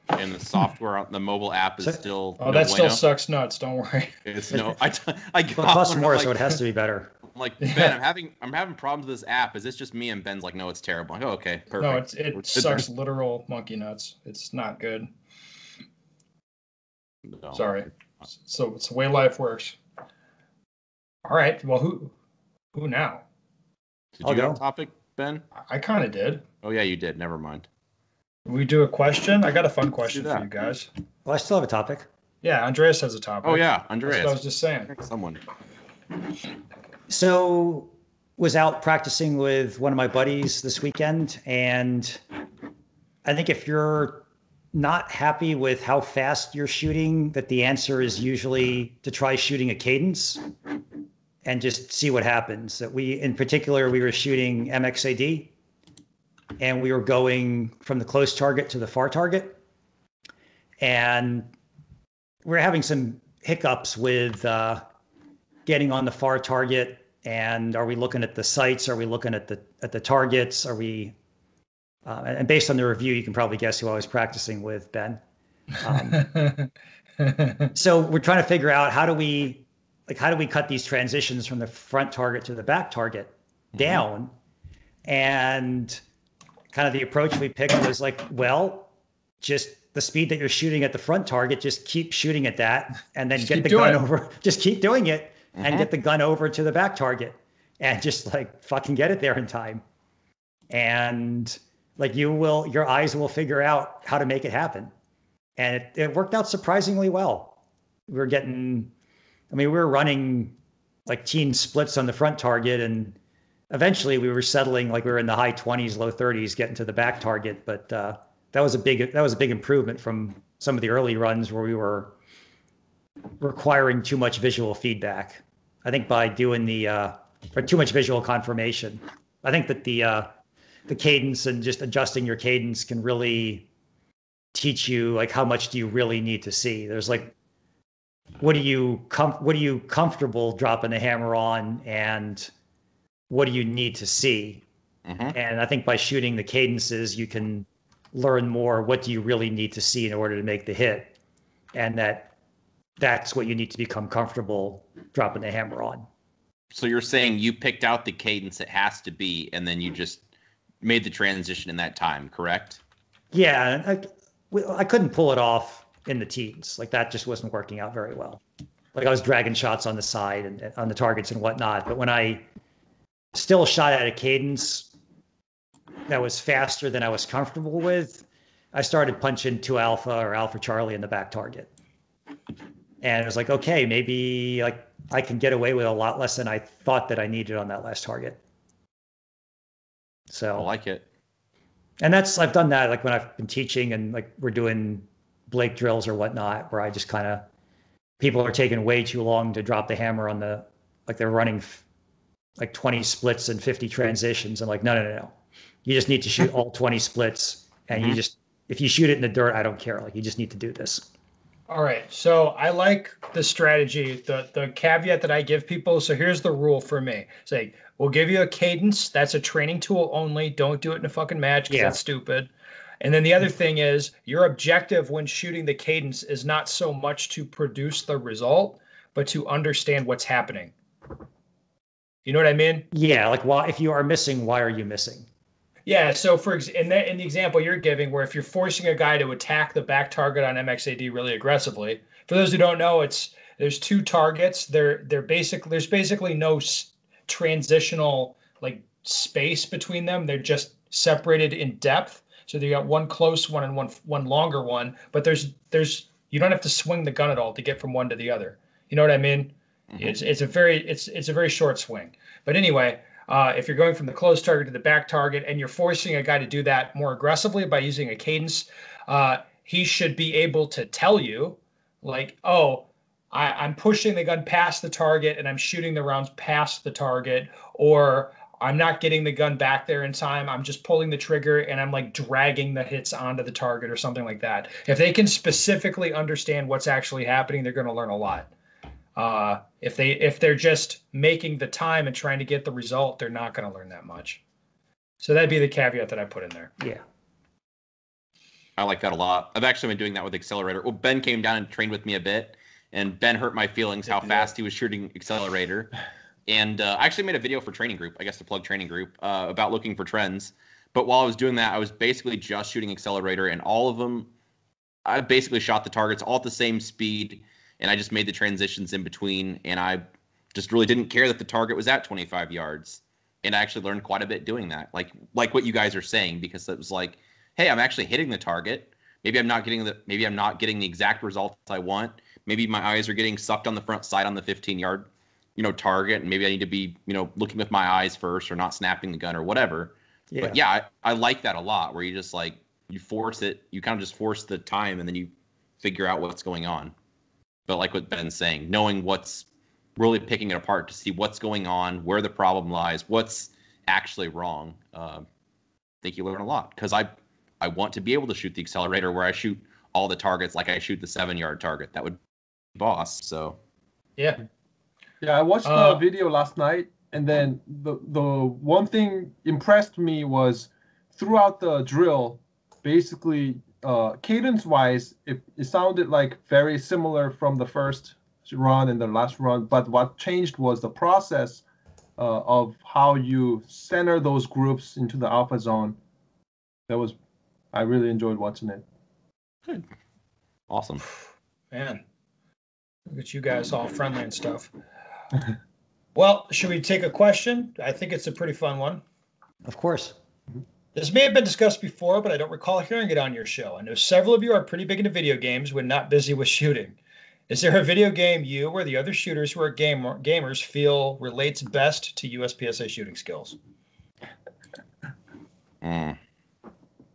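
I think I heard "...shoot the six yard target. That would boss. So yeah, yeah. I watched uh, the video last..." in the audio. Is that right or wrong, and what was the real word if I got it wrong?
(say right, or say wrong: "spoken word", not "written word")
wrong: "seven", not "six".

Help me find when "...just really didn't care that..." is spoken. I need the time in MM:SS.
05:20.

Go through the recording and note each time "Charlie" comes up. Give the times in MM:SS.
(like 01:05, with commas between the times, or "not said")
03:00.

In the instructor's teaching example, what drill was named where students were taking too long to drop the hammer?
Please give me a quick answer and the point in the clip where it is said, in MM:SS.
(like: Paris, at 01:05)
Blake drills, at 03:15.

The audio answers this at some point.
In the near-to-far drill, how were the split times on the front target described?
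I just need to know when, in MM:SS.
01:51.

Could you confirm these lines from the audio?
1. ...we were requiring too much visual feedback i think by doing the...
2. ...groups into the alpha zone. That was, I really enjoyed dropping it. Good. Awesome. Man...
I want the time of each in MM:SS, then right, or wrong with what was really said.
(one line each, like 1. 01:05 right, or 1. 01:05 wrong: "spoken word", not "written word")
1. 02:01 right
2. 06:24 wrong: "watching", not "dropping".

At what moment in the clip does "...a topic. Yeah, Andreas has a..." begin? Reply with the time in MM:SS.
00:31.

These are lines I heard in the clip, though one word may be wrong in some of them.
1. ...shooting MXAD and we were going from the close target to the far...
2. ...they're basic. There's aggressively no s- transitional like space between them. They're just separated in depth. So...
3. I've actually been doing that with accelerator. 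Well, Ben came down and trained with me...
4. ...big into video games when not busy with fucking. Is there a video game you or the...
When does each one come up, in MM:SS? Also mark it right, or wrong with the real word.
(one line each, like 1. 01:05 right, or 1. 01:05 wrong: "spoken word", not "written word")
1. 00:54 right
2. 04:05 wrong: "basically", not "aggressively"
3. 04:59 right
4. 06:44 wrong: "shooting", not "fucking".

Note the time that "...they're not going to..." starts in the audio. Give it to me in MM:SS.
04:53.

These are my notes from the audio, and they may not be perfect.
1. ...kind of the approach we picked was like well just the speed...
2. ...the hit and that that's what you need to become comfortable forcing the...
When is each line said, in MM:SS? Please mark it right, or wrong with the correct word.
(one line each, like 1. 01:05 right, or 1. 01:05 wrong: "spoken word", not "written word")
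1. 01:26 right
2. 02:30 wrong: "dropping", not "forcing".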